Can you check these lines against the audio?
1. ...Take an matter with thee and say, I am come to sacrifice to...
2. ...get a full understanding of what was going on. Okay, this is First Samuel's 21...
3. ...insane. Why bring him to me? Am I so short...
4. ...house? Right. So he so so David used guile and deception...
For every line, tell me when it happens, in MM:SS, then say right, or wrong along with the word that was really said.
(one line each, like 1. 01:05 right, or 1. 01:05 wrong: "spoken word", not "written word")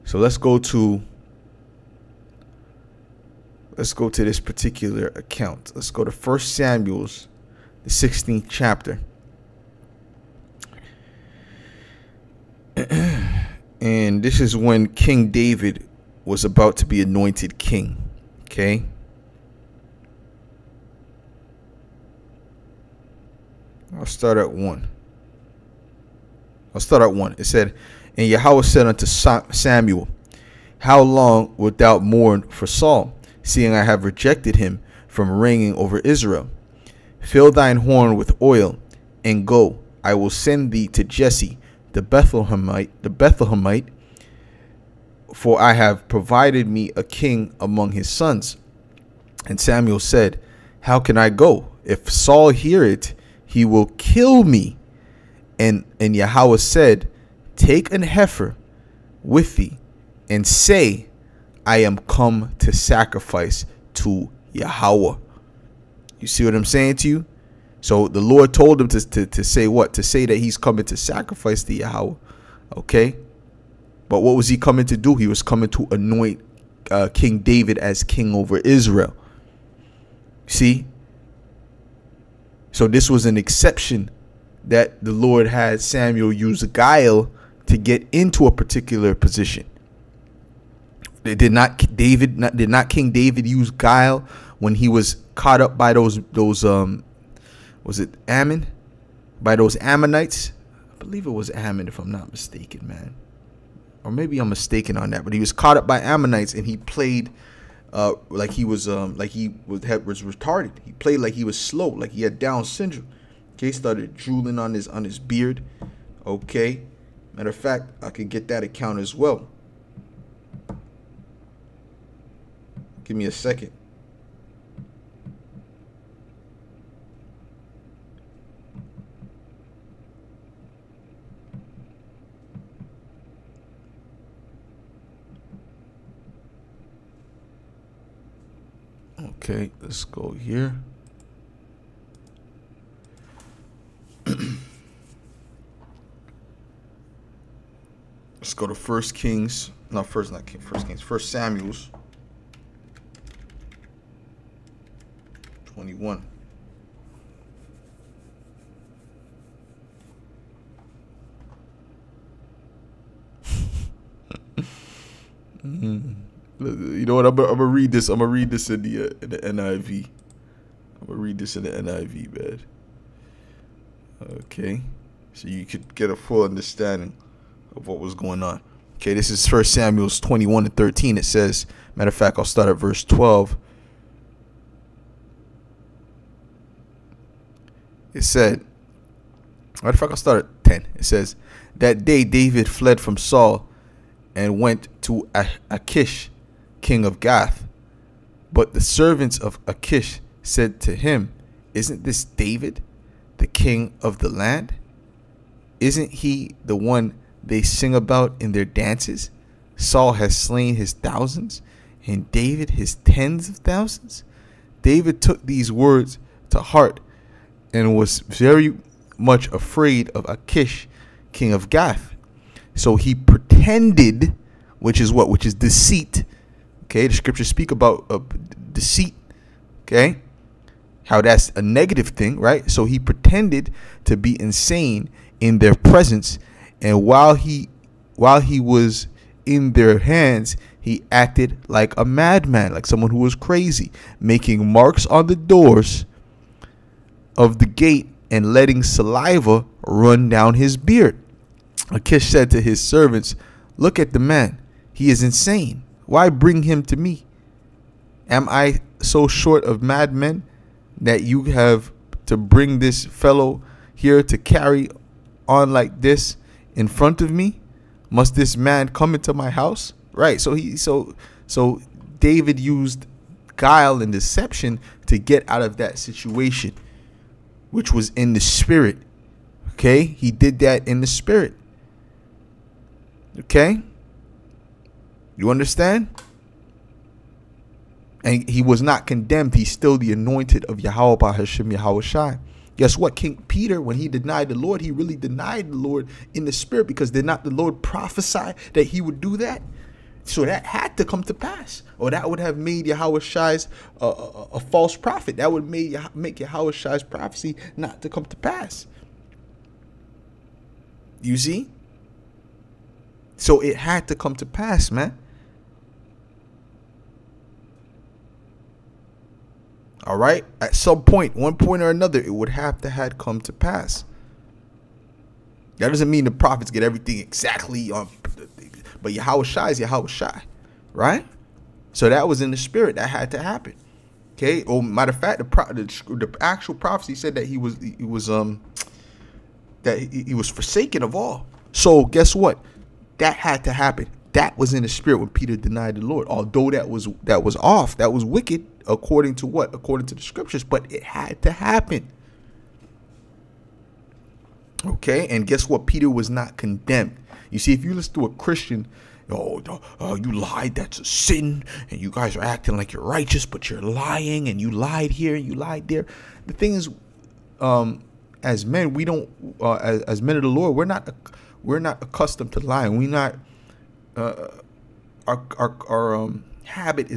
1. 00:57 wrong: "heifer", not "matter"
2. 02:55 right
3. 04:15 right
4. 04:29 right.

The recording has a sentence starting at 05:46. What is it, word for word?
Although that was that was off, that was wicked according to what?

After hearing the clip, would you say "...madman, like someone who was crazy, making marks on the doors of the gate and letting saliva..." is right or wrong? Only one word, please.
right.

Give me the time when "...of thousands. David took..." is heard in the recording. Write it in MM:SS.
03:33.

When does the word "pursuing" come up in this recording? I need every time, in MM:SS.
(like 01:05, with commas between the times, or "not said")
not said.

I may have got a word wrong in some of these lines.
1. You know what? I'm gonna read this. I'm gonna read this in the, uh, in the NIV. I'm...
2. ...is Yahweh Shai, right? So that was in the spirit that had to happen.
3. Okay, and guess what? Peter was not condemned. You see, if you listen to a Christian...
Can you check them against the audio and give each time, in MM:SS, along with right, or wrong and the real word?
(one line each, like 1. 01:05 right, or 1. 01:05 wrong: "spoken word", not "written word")
1. 02:46 right
2. 05:29 right
3. 05:54 right.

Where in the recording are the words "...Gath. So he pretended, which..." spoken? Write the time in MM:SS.
03:41.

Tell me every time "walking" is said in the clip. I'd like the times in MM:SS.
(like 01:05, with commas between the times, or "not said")
not said.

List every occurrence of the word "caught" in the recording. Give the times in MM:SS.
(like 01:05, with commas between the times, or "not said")
01:35, 01:45.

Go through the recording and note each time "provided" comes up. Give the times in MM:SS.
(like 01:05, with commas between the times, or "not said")
00:46.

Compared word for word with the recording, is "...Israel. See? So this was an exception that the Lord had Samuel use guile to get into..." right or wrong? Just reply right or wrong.
right.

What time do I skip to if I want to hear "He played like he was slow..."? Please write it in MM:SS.
01:50.